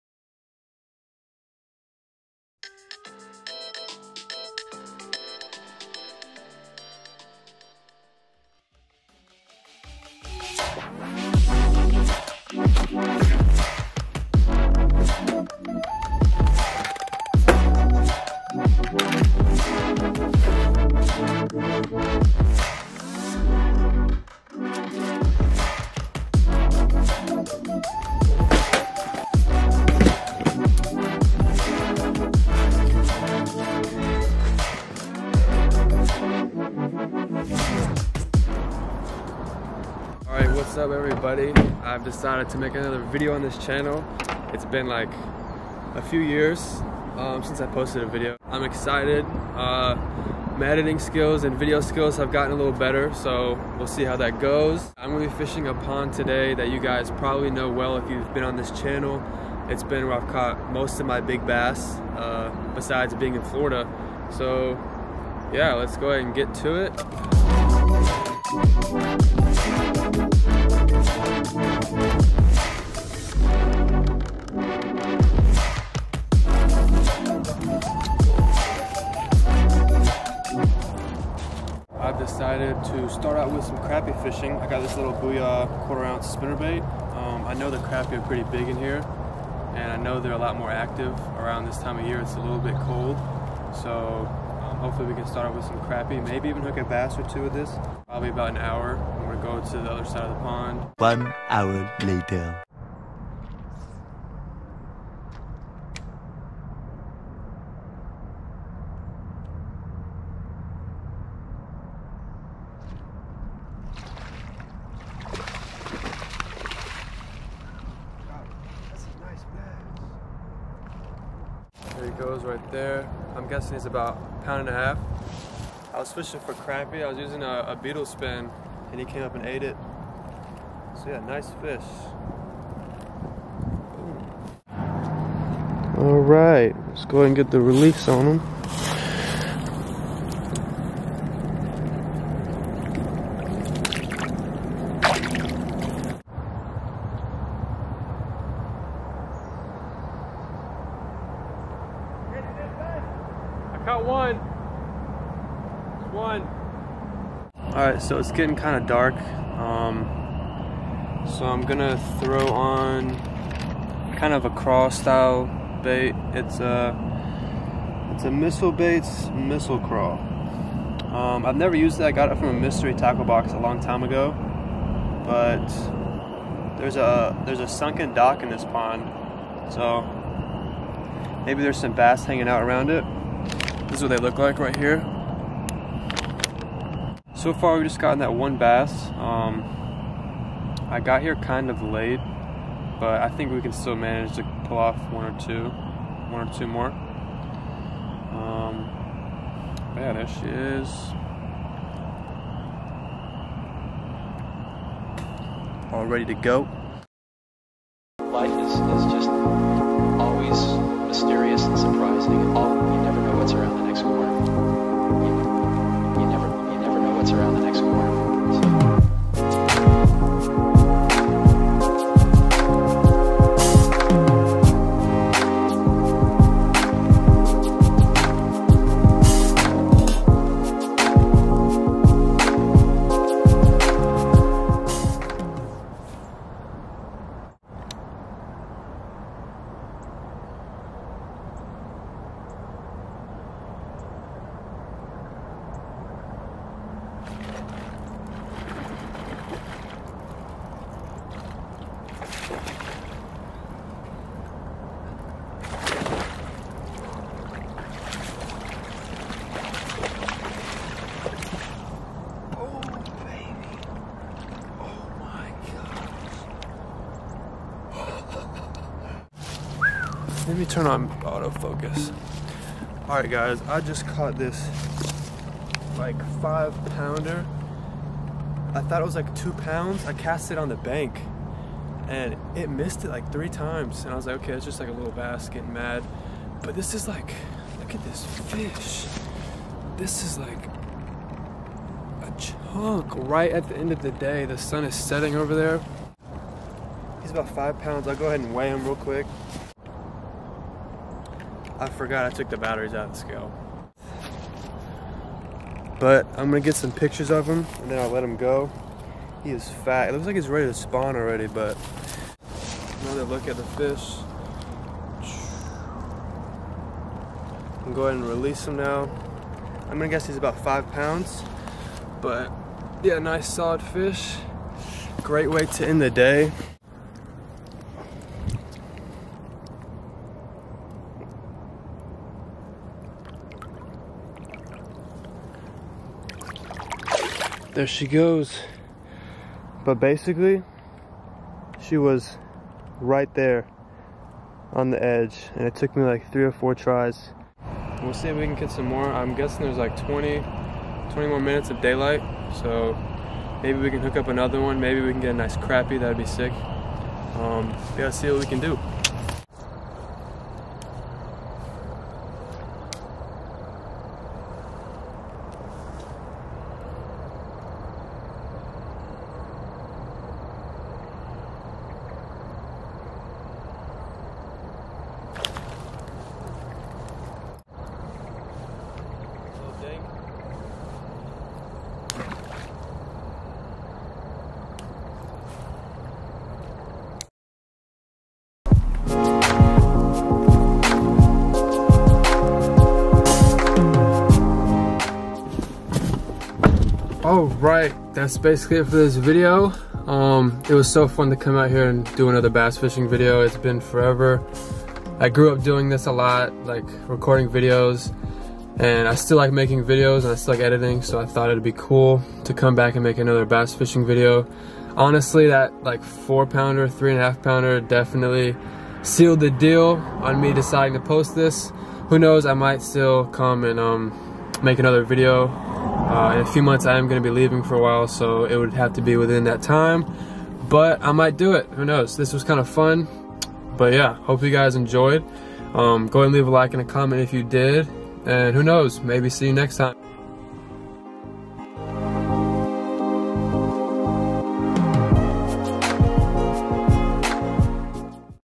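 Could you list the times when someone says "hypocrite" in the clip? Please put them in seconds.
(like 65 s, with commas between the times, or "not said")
not said.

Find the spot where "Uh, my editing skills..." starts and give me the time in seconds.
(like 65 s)
49 s.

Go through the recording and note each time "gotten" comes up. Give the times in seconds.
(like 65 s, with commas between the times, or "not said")
52 s, 187 s.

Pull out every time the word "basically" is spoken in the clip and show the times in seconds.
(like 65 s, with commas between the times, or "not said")
339 s, 398 s.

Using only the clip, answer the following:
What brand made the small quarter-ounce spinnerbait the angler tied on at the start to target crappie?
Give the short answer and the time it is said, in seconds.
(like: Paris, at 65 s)
Booyah, at 85 s.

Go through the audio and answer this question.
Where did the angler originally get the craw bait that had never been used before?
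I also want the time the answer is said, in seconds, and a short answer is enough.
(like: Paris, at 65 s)
A mystery tackle box, at 172 s.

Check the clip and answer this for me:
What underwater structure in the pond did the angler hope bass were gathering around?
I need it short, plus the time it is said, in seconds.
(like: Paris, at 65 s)
A sunken dock, at 177 s.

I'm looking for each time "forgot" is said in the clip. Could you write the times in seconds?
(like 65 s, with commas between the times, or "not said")
301 s.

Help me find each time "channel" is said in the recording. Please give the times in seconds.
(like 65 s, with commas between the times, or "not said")
43 s, 58 s.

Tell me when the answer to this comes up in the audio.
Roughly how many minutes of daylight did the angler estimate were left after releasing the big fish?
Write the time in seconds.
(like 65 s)
351 s.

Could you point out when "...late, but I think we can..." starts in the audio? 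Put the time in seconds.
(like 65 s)
191 s.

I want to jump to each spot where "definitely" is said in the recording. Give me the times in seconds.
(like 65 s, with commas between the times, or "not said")
417 s.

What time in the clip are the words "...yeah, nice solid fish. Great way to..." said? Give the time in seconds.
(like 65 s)
323 s.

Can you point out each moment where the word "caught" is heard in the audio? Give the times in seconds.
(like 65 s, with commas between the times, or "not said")
60 s, 274 s.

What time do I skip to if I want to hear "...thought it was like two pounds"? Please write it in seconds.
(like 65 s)
278 s.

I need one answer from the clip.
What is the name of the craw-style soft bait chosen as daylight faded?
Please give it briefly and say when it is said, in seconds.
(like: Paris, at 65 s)
Missile Craw, at 169 s.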